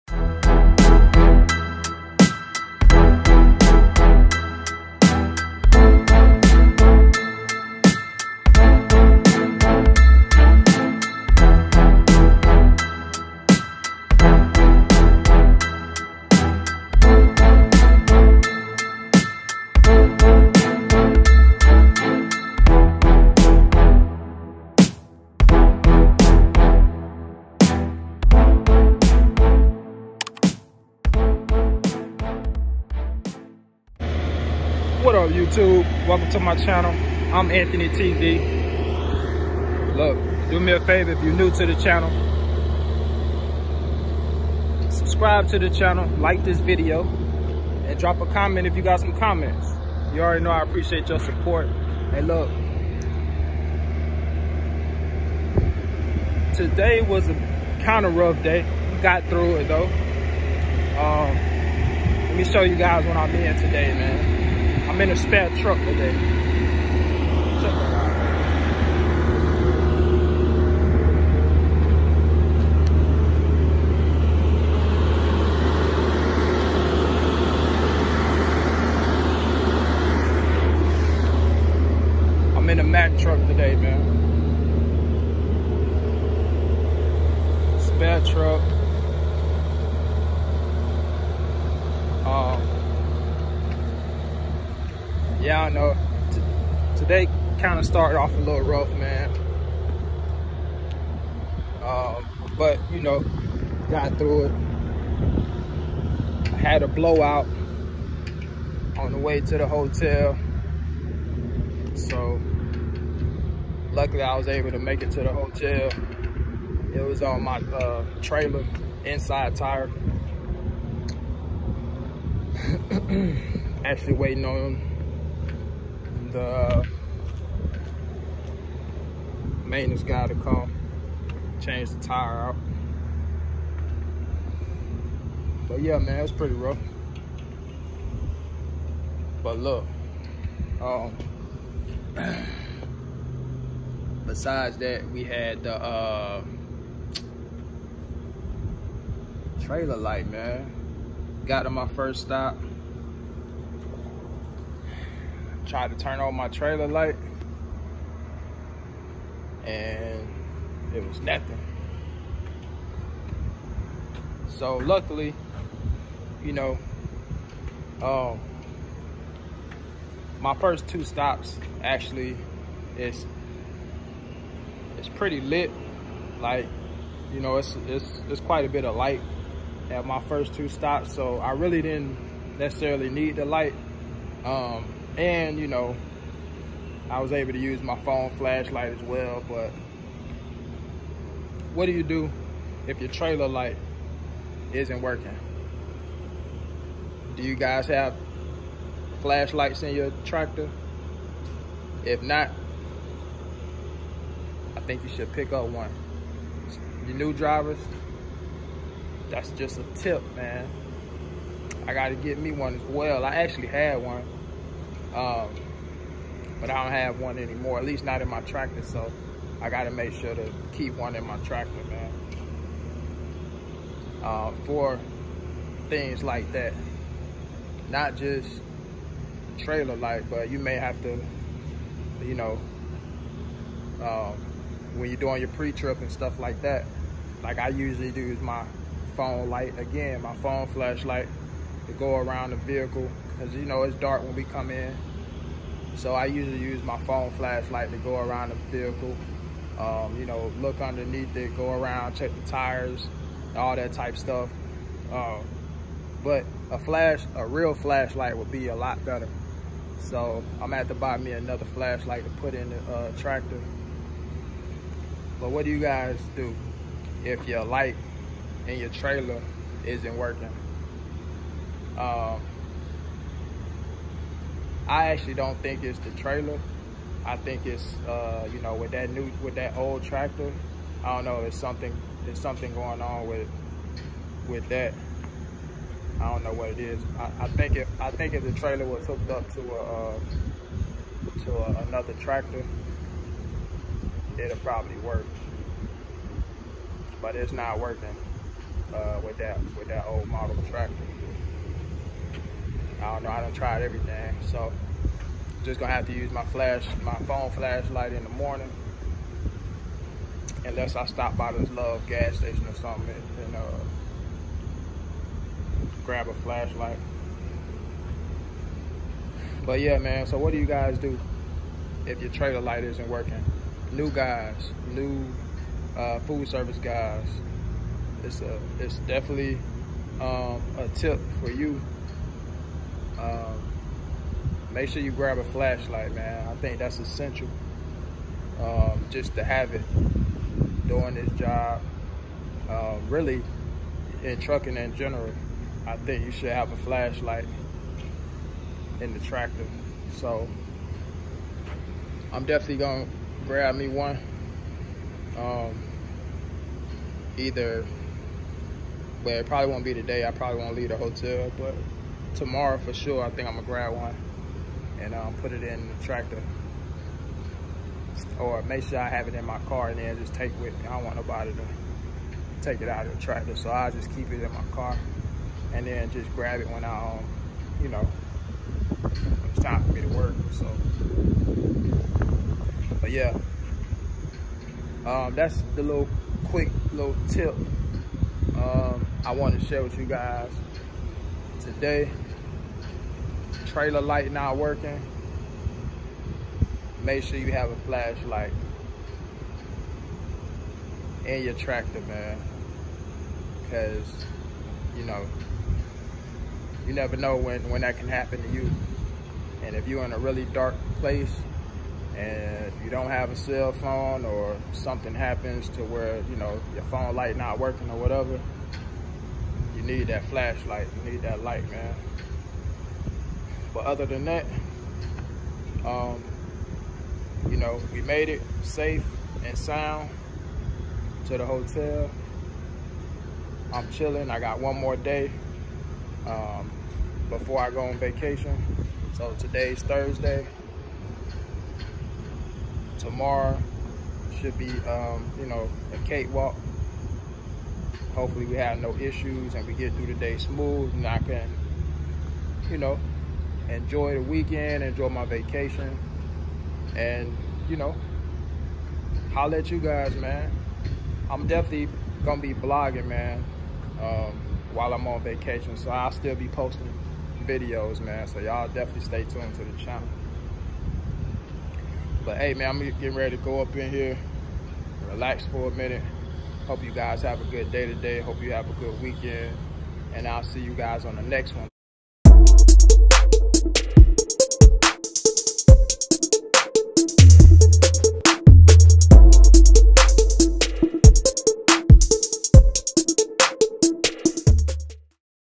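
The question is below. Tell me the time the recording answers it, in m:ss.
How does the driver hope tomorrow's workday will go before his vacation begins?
7:25.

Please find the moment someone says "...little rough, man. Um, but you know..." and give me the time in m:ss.
1:38.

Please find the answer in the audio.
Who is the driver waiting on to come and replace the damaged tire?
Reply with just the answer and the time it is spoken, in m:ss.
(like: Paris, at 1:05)
maintenance guy, at 2:09.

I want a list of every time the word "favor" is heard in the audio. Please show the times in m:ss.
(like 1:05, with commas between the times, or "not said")
0:40.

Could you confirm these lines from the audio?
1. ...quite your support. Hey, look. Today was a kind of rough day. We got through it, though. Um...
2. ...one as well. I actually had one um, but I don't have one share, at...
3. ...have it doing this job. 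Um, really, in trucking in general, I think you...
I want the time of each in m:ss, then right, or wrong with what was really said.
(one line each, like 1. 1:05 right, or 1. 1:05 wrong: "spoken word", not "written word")
1. 0:50 wrong: "appreciate", not "quite"
2. 3:32 wrong: "anymore", not "share"
3. 5:39 right.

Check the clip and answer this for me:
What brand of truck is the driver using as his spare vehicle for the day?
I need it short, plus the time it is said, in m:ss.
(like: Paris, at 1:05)
Mack, at 1:22.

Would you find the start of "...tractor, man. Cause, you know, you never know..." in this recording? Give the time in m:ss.
6:41.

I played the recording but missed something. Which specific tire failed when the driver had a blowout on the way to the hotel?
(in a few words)
trailer inside tire.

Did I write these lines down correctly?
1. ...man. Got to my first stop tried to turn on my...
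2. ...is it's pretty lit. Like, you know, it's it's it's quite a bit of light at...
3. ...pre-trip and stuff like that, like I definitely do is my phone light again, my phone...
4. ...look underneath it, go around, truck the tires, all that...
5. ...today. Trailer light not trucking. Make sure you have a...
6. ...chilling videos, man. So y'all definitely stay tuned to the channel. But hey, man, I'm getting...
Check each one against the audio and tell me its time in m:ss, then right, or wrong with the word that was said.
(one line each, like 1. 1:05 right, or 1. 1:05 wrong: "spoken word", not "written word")
1. 2:30 right
2. 2:52 right
3. 3:55 wrong: "usually", not "definitely"
4. 4:10 wrong: "check", not "truck"
5. 6:31 wrong: "working", not "trucking"
6. 7:46 wrong: "posting", not "chilling".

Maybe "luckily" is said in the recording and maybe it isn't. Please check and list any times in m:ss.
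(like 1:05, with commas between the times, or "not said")
1:53, 2:44.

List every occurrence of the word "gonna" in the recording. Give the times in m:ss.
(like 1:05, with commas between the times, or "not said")
4:20, 5:05, 5:52, 6:03, 7:42.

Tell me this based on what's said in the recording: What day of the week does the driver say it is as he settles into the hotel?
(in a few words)
Thursday.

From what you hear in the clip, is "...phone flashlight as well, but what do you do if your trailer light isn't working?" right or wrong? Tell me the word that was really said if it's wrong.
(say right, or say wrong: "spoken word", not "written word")
right.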